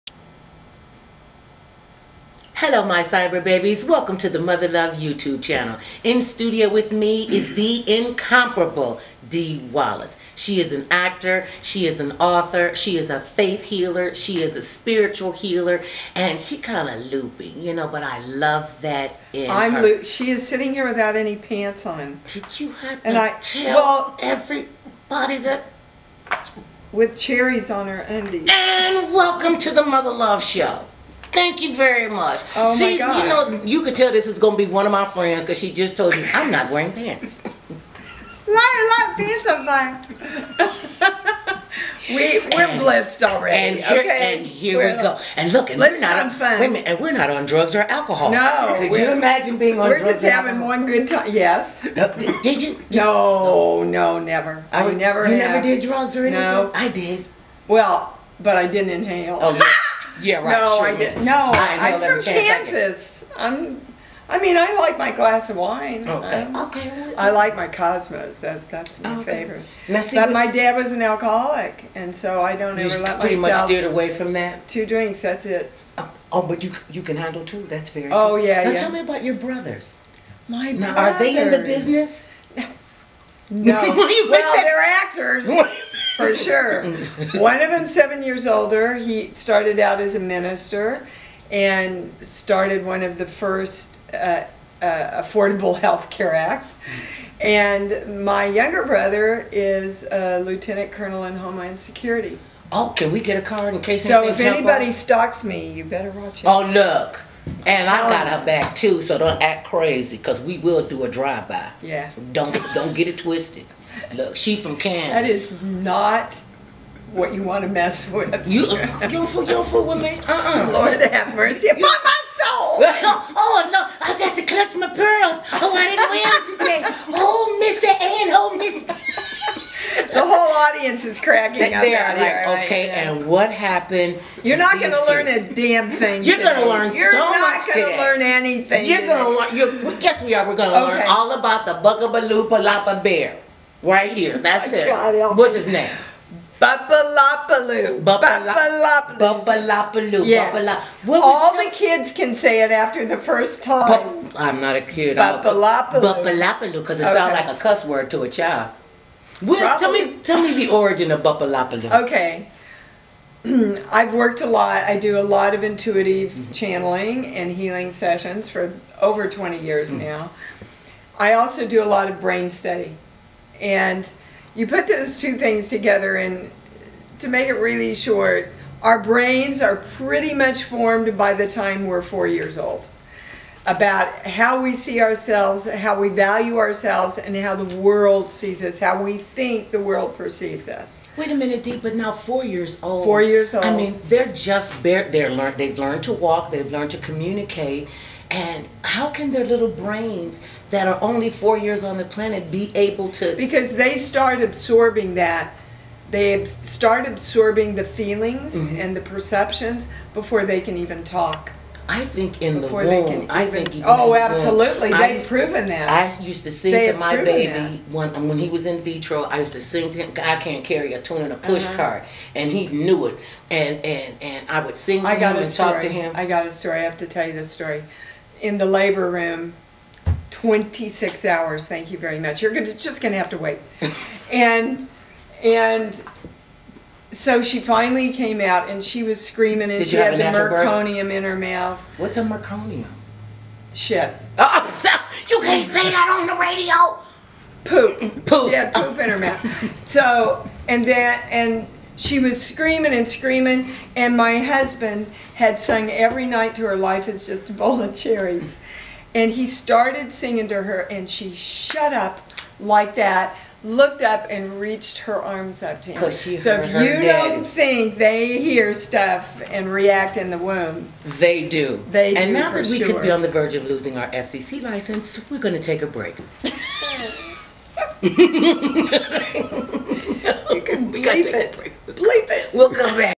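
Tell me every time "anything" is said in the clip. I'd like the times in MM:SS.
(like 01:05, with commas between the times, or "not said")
00:56, 02:18.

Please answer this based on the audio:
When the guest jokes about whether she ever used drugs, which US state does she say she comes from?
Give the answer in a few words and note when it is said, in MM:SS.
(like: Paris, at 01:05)
Kansas, at 01:02.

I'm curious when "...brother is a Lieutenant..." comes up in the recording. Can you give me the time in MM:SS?
01:38.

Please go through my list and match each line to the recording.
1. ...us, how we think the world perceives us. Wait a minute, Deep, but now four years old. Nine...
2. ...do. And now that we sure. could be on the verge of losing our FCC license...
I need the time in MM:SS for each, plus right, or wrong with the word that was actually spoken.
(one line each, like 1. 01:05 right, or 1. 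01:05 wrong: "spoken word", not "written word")
1. 03:08 wrong: "Four", not "Nine"
2. 04:32 right.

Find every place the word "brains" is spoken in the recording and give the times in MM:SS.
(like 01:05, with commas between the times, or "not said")
02:52, 02:58, 03:19.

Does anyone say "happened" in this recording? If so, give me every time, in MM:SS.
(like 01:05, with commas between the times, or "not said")
02:13.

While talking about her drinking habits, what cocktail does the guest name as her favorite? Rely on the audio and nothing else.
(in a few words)
Cosmos.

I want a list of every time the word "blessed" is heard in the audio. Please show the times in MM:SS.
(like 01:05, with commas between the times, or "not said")
00:42.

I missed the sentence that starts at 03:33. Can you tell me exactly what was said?
Even, I think even oh, absolutely.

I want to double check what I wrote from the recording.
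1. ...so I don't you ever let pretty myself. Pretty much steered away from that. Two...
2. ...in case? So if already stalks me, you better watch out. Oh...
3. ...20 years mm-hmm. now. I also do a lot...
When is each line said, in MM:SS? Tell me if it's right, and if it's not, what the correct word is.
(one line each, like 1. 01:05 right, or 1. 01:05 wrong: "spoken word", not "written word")
1. 01:12 right
2. 01:43 wrong: "anybody", not "already"
3. 02:49 right.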